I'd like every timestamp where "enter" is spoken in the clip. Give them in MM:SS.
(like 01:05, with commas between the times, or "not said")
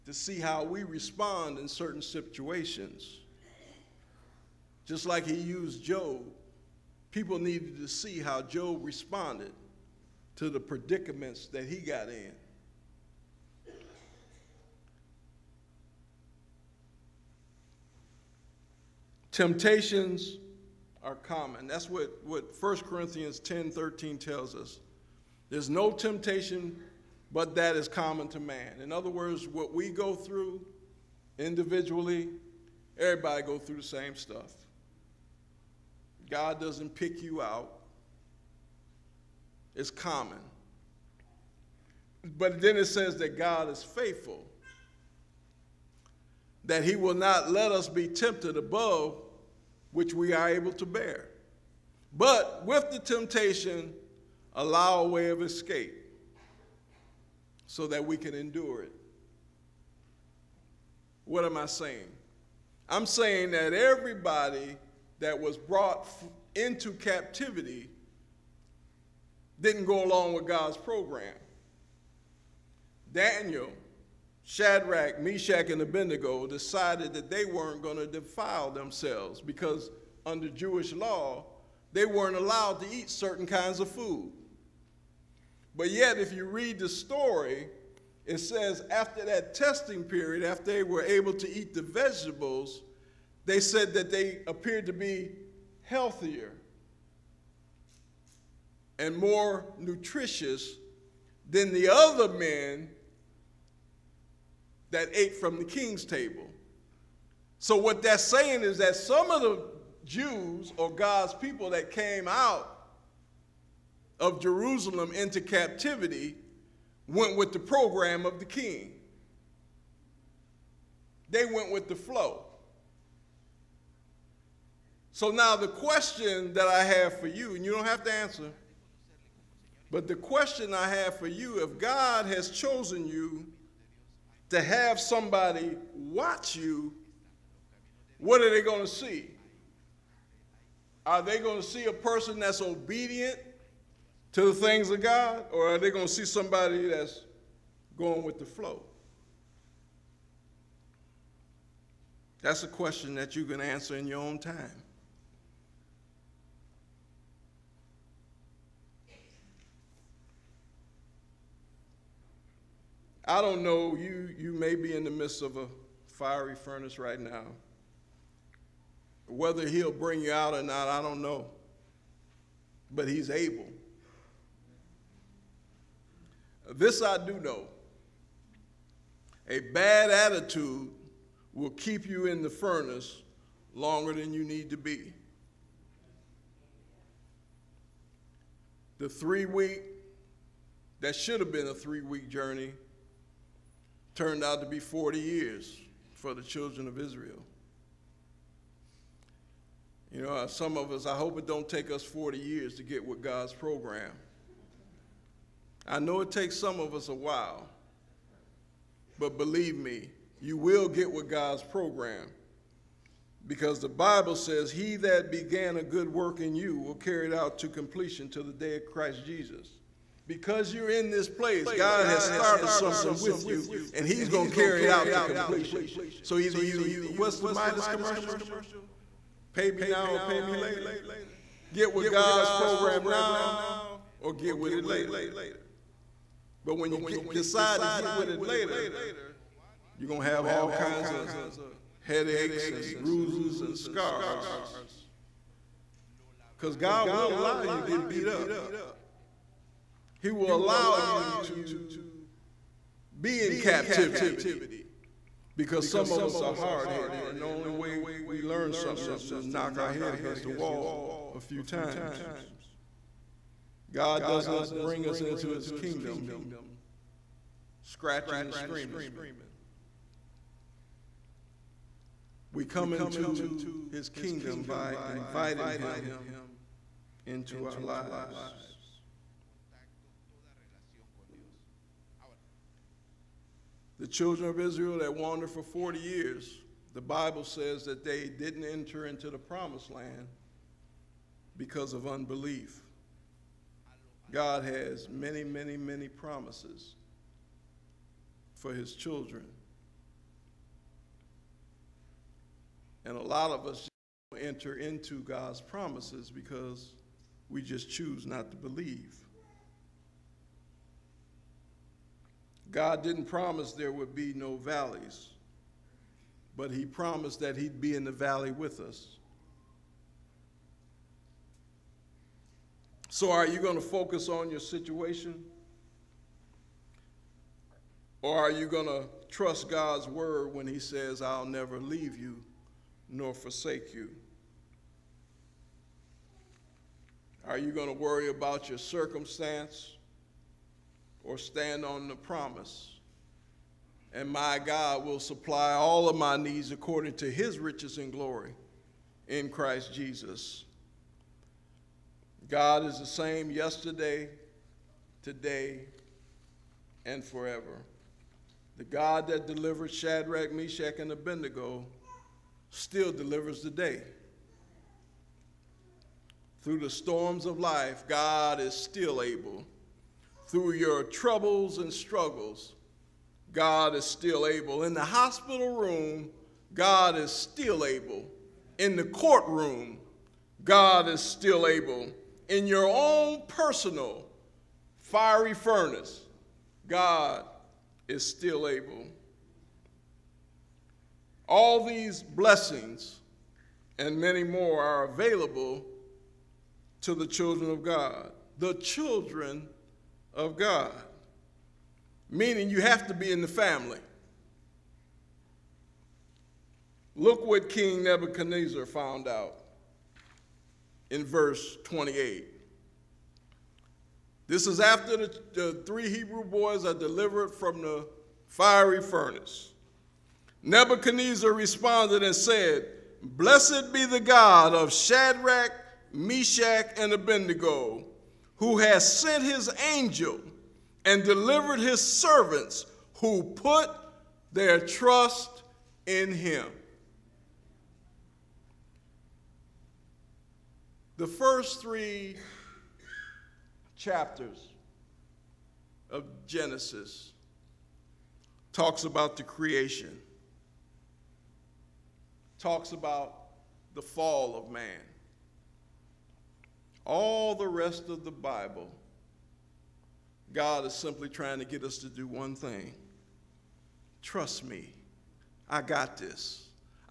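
04:48, 05:04.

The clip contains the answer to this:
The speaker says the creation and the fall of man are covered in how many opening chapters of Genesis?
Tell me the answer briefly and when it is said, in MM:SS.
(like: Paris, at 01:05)
3, at 07:21.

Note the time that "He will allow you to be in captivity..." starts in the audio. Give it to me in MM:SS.
04:10.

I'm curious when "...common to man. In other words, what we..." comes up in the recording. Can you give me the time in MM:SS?
00:27.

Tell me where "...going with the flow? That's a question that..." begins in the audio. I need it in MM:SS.
02:27.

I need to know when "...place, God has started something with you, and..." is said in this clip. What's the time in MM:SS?
03:41.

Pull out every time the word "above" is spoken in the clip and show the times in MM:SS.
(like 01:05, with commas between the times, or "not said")
00:48.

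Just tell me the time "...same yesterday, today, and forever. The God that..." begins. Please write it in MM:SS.
05:53.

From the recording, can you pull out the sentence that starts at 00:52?
But with the temptation, allow a way of escape so that we can endure it.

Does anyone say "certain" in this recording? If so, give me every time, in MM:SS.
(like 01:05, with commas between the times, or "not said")
00:01, 01:23.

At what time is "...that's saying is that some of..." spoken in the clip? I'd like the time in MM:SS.
01:48.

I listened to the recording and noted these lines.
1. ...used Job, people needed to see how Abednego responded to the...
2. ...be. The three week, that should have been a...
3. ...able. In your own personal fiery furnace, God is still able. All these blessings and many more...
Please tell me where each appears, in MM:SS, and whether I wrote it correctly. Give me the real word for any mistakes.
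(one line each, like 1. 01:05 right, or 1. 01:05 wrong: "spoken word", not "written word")
1. 00:05 wrong: "Job", not "Abednego"
2. 03:04 right
3. 06:21 right.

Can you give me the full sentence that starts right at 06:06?
Through the storms of life, God is still able through your troubles and struggles, God is still able.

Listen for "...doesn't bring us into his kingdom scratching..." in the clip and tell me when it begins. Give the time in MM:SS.
04:24.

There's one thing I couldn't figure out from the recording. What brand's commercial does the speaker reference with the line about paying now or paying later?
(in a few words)
Midas.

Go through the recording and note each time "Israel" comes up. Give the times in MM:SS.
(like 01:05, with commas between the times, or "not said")
03:16, 04:44.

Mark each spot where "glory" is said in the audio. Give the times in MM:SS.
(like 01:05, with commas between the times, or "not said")
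05:48.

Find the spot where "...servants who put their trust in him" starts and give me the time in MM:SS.
07:11.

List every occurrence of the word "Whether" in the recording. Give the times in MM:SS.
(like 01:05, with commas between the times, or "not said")
02:49.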